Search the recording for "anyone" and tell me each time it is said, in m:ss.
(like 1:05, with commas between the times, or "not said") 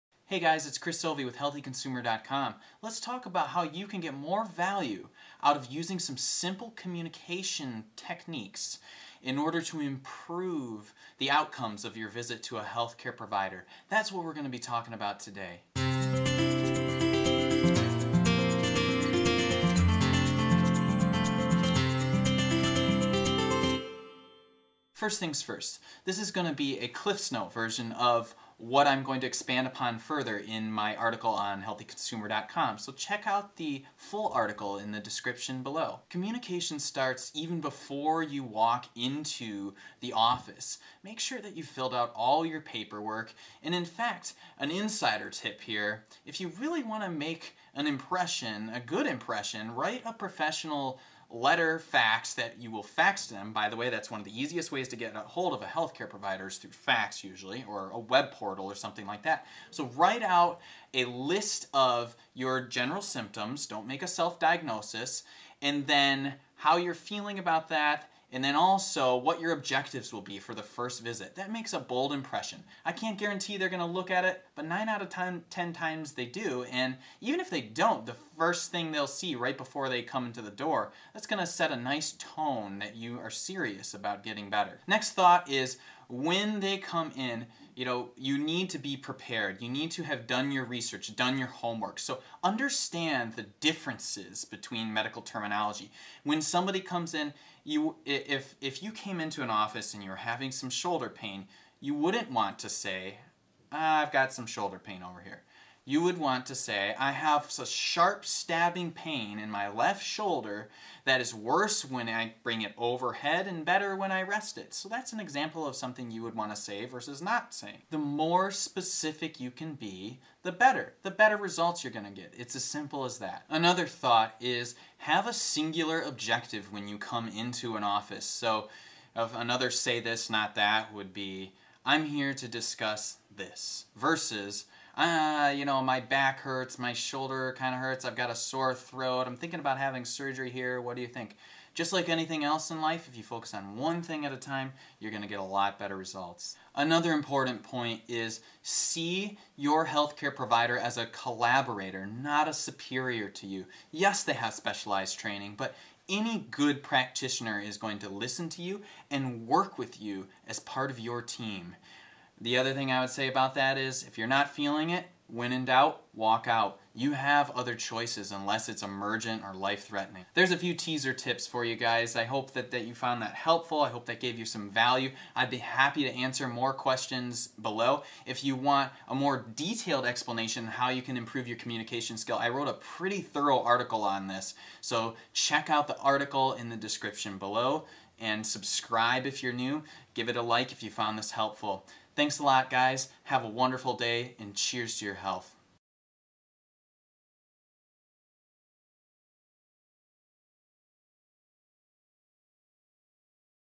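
not said.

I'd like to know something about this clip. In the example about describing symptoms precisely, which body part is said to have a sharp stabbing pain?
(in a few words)
Left shoulder.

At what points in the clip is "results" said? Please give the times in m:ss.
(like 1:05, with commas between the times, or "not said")
2:01, 2:25.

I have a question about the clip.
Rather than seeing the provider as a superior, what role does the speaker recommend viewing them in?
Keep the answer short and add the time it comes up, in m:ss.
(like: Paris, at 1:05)
Collaborator, at 2:31.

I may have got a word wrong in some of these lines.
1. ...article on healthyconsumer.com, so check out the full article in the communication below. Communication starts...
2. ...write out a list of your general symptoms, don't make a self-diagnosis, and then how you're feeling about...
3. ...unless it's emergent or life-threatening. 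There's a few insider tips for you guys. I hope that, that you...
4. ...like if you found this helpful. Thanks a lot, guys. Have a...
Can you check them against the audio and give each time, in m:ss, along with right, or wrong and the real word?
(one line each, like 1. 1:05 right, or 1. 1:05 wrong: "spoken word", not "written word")
1. 0:30 wrong: "description", not "communication"
2. 0:59 right
3. 2:48 wrong: "teaser", not "insider"
4. 3:10 right.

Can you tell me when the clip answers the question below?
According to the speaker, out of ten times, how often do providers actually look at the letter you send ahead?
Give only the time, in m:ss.
1:14.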